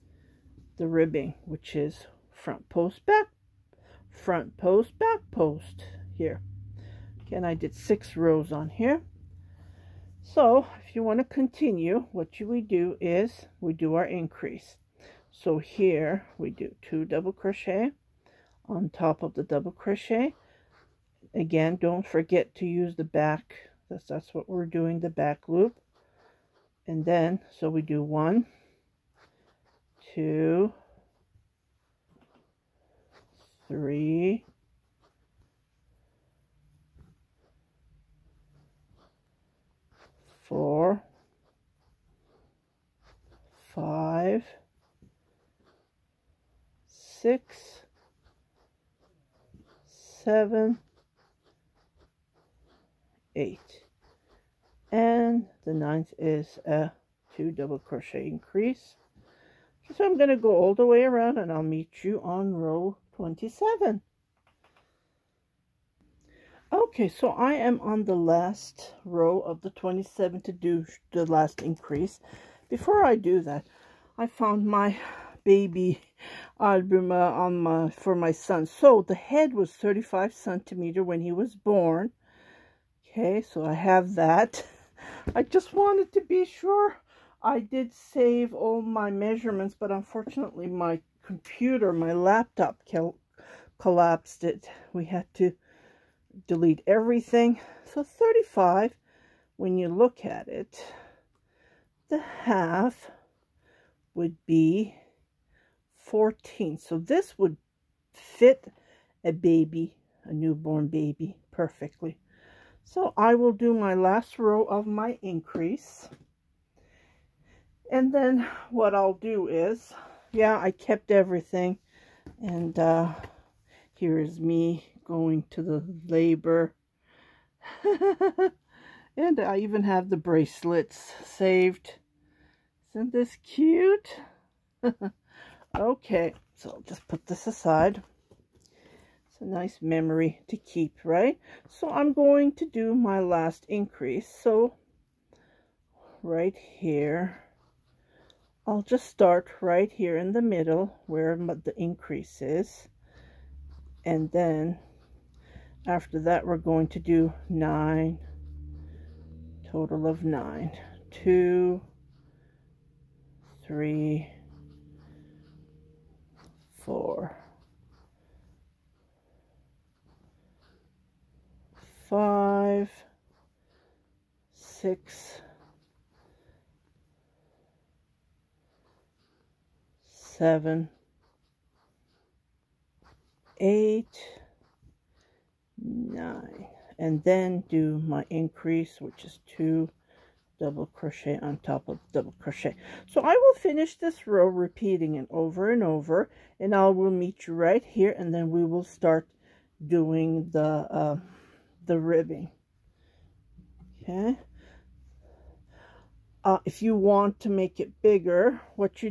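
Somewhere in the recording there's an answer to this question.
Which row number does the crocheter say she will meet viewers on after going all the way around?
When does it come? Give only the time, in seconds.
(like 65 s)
62 s.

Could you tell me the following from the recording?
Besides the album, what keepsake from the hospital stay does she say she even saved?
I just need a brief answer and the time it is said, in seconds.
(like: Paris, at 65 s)
the bracelets, at 130 s.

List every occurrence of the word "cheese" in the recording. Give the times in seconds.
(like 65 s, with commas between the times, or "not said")
not said.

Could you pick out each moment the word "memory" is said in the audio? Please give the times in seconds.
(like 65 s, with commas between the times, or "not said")
139 s.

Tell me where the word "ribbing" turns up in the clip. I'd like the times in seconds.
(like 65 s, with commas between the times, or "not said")
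0 s, 201 s.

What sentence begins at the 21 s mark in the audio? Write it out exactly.
Again, don't forget to use the back.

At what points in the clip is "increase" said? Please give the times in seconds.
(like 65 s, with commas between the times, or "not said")
14 s, 58 s, 71 s, 115 s, 143 s, 151 s, 188 s.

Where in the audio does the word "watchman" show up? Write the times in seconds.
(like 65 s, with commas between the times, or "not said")
not said.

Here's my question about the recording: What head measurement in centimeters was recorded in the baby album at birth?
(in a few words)
35 centimeters.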